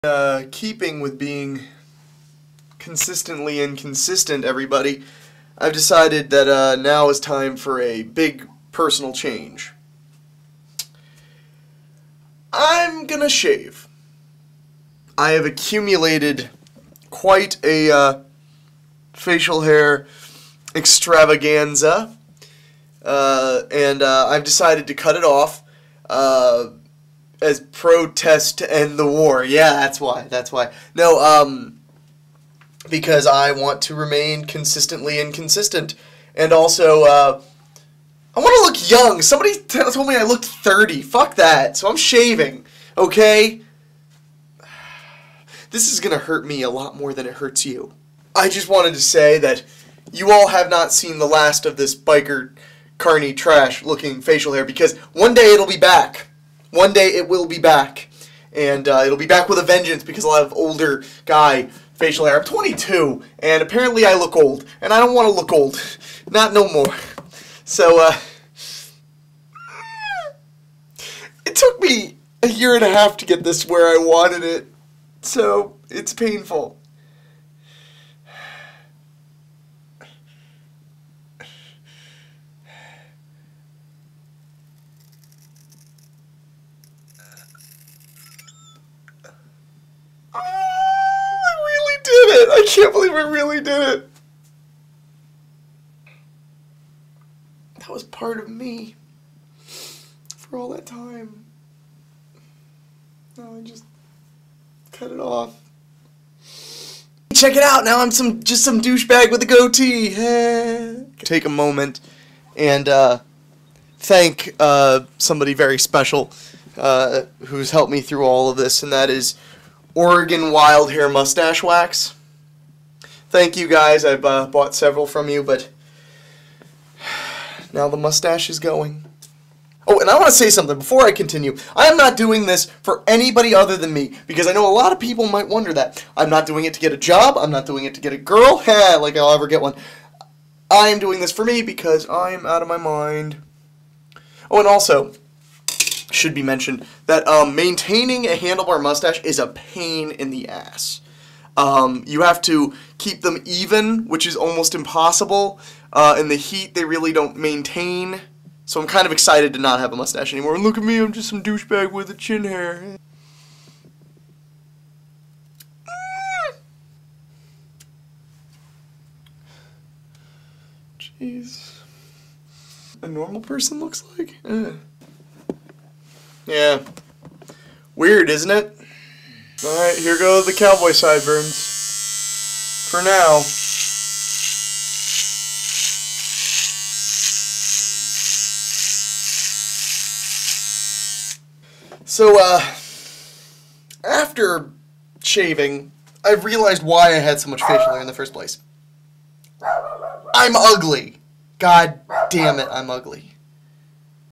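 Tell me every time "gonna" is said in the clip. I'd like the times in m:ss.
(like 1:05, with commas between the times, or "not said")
0:13, 0:46.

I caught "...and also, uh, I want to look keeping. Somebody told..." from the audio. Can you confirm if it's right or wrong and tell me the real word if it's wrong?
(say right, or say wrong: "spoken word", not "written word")
wrong: "young", not "keeping".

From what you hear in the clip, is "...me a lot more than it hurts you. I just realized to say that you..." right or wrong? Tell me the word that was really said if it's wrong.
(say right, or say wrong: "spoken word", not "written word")
wrong: "wanted", not "realized".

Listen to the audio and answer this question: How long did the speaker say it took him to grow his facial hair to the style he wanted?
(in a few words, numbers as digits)
A year and a half.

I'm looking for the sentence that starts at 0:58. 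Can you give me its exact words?
And uh, it'll be back with a vengeance because I'll have older guy facial hair.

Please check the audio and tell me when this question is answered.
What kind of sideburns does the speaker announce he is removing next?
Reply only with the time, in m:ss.
3:00.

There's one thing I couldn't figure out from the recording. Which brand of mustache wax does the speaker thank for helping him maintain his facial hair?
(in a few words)
Oregon Wild Hair.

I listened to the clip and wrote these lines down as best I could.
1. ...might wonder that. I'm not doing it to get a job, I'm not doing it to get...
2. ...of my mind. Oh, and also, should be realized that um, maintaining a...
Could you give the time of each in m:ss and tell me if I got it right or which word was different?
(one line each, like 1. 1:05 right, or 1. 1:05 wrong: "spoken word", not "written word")
1. 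2:15 right
2. 2:22 wrong: "mentioned", not "realized".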